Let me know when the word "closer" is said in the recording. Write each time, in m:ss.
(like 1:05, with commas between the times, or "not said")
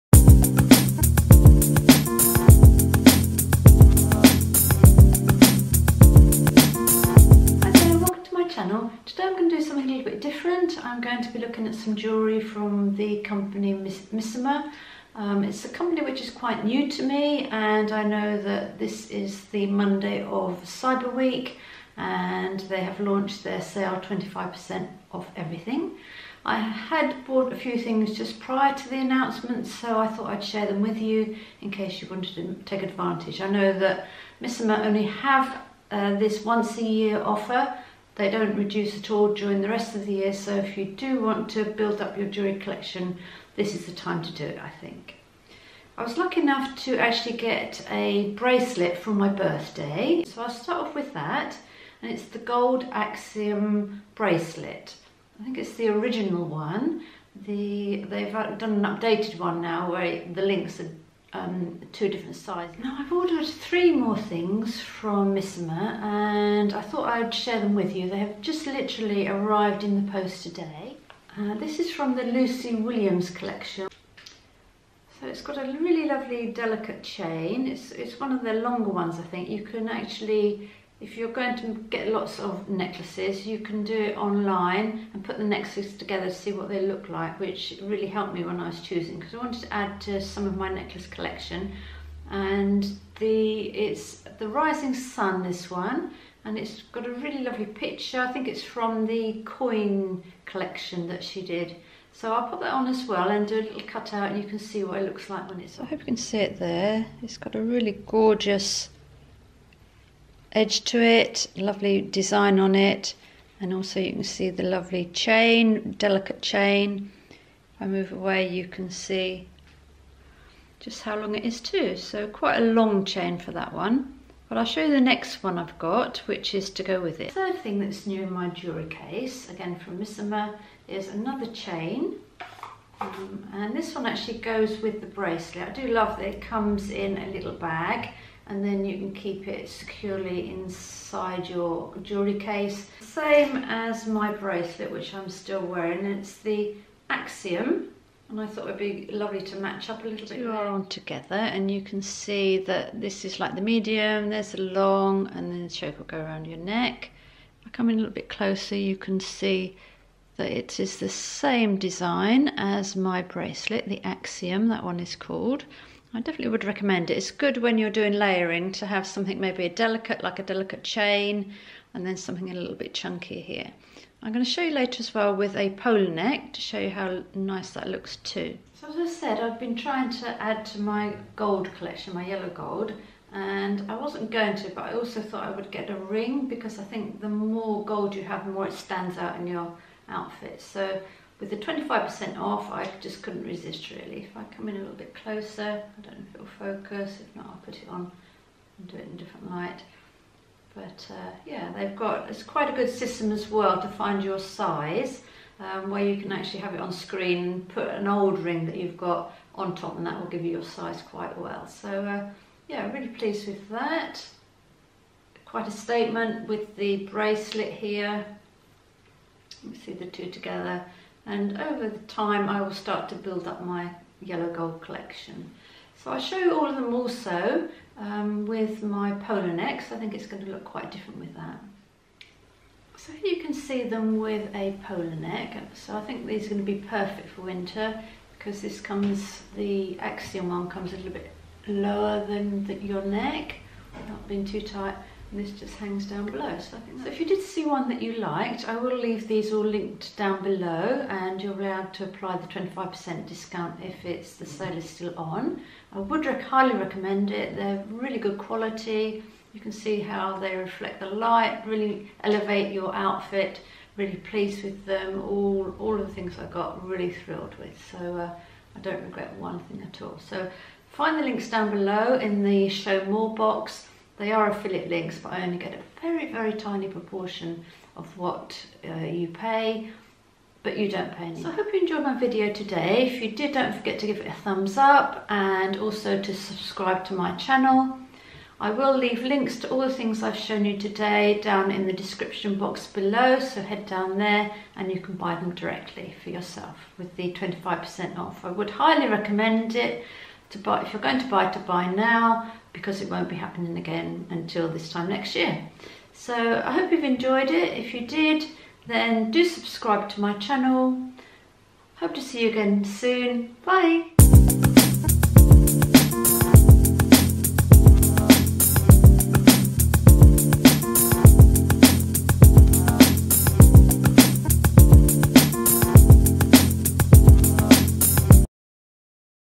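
2:38, 3:15.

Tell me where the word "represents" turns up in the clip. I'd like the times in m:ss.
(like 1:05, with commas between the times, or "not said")
not said.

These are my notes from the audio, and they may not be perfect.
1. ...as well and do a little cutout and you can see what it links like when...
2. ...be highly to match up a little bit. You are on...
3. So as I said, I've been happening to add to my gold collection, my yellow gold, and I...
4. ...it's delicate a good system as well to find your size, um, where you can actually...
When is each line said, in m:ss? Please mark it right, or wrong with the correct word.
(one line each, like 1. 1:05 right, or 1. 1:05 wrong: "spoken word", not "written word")
1. 1:42 wrong: "looks", not "links"
2. 2:28 wrong: "lovely", not "highly"
3. 2:58 wrong: "trying", not "happening"
4. 3:22 wrong: "quite", not "delicate".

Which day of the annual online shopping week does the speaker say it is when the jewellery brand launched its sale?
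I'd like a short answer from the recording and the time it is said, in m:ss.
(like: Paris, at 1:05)
Monday, at 0:19.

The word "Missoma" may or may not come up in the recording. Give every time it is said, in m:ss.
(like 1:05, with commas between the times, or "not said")
0:13, 0:34, 1:05, 2:09.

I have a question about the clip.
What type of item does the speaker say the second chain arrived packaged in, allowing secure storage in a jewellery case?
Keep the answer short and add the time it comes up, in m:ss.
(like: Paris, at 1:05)
a little bag, at 2:17.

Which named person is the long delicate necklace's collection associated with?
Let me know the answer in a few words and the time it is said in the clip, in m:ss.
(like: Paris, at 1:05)
Lucy Williams, at 1:12.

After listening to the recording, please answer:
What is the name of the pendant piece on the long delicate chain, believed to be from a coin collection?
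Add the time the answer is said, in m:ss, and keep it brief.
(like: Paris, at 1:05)
Rising Sun, at 1:34.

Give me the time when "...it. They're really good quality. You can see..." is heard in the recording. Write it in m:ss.
4:17.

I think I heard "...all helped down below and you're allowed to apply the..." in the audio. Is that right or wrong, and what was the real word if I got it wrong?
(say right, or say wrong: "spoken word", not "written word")
wrong: "linked", not "helped".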